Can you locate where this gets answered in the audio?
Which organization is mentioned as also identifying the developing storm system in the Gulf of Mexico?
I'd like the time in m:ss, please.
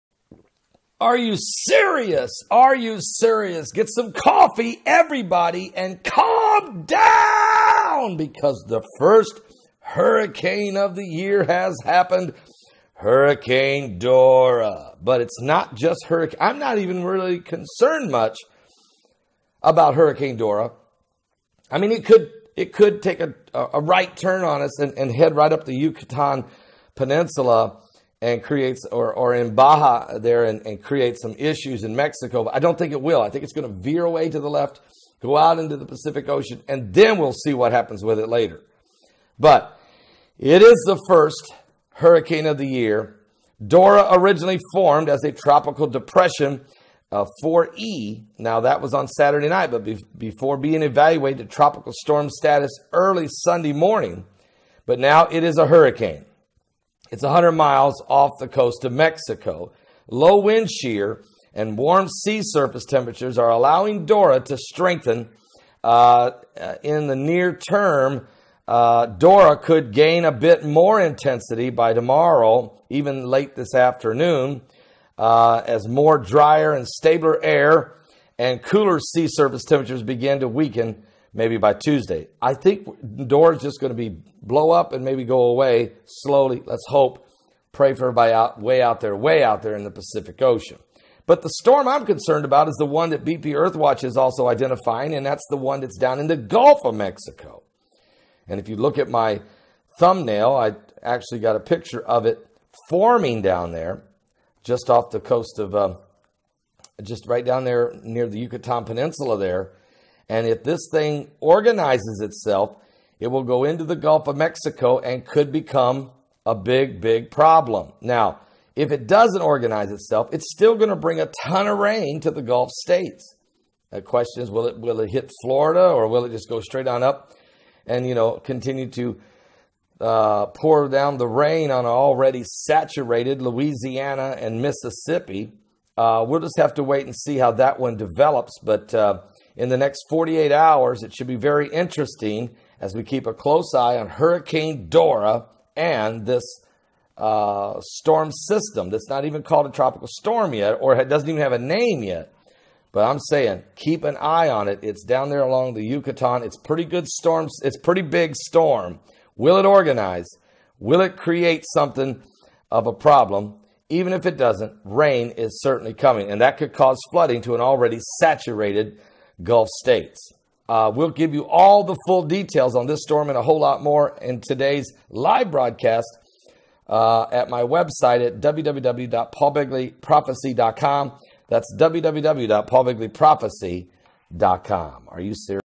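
1:33.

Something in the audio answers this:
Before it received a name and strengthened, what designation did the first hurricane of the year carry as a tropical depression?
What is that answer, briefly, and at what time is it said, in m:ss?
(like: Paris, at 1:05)
4E, at 0:47.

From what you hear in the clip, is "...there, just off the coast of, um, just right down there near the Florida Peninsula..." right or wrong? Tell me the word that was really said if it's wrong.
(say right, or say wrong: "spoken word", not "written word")
wrong: "Yucatan", not "Florida".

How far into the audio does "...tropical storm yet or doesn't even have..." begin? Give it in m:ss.
2:29.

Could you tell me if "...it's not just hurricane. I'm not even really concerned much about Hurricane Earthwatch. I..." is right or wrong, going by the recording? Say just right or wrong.
wrong.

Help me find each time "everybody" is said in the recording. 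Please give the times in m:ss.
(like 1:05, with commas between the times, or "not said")
0:04, 1:28.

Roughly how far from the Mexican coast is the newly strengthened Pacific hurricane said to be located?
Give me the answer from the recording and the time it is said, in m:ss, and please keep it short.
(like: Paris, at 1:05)
100 miles, at 0:57.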